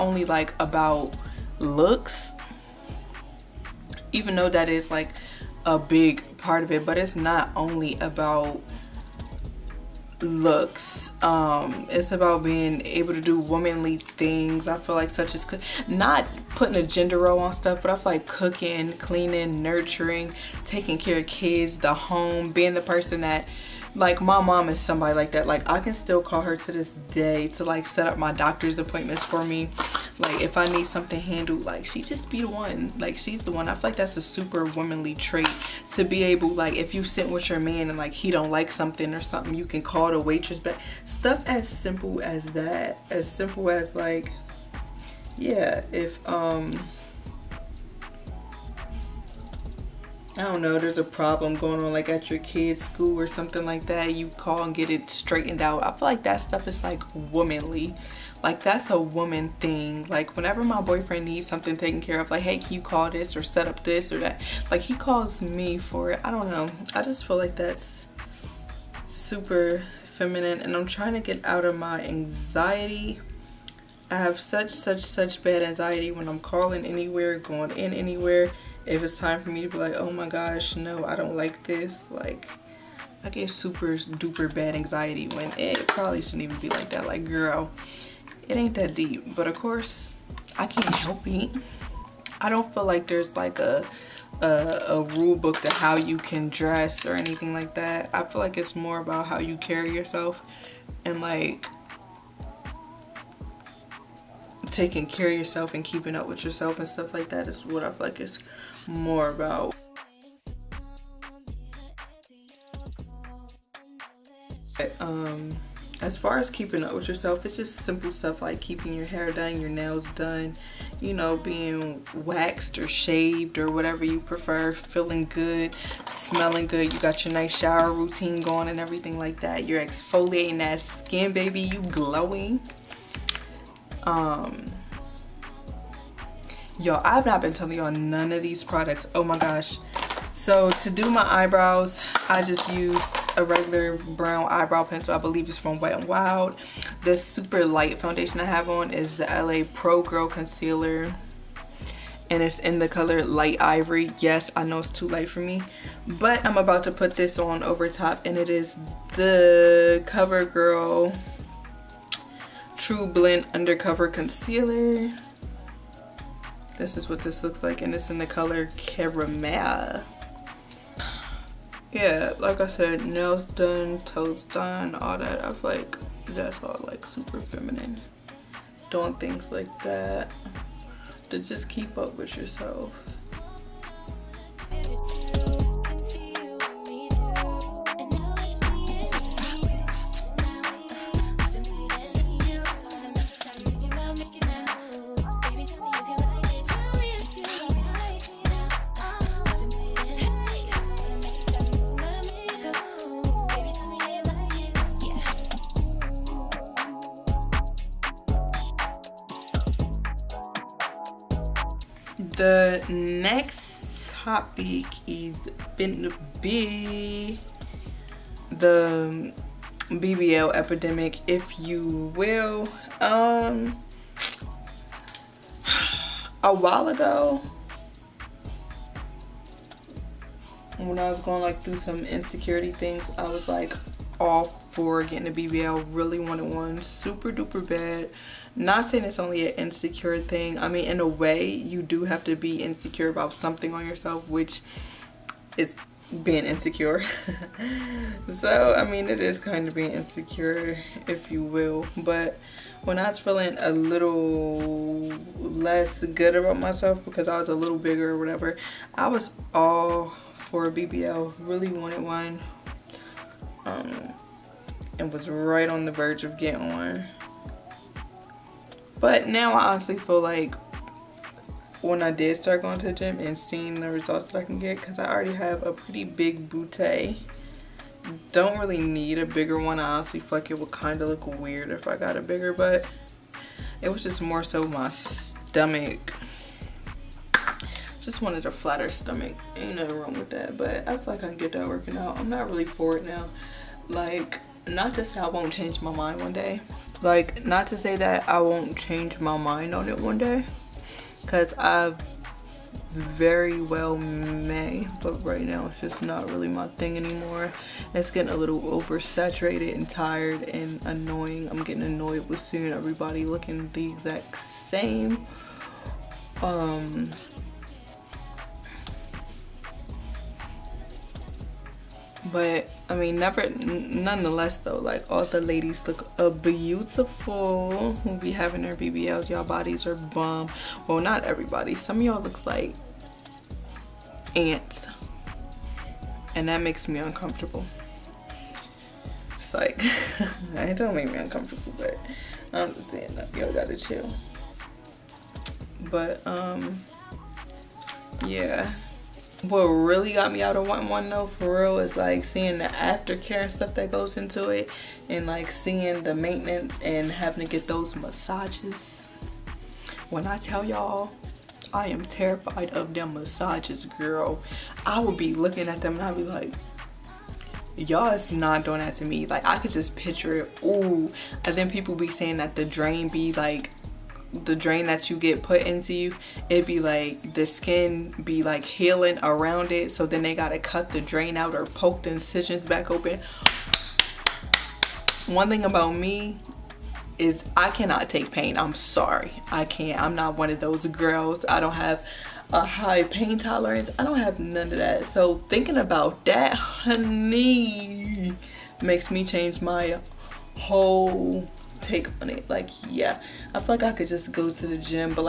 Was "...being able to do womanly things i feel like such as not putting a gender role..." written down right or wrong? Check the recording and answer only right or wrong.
right.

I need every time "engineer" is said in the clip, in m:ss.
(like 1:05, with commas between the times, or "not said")
not said.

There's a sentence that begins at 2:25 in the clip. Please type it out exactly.
I believe it's from Wet n Wild.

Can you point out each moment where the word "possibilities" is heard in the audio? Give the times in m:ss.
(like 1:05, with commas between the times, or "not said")
not said.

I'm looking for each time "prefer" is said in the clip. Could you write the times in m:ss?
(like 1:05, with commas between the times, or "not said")
2:04.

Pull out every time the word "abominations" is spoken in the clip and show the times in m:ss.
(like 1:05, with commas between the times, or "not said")
not said.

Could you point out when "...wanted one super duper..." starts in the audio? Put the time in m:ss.
3:56.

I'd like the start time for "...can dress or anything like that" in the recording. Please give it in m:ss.
1:36.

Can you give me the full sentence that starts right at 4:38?
Don't really need a bigger one.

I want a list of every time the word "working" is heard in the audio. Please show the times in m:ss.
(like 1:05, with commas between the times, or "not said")
4:51.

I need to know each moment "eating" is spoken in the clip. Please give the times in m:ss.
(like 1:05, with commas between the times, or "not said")
not said.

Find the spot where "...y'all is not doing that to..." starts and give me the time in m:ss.
6:07.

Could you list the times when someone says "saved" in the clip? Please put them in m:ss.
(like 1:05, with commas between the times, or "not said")
not said.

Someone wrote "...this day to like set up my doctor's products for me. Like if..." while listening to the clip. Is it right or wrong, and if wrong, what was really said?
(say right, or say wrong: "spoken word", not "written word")
wrong: "appointments", not "products".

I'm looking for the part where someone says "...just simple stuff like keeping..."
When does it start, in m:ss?
1:57.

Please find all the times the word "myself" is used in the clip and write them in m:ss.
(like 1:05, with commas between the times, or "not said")
4:16.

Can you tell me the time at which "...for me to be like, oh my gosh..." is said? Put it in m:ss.
1:19.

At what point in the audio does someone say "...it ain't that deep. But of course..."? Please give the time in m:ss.
1:28.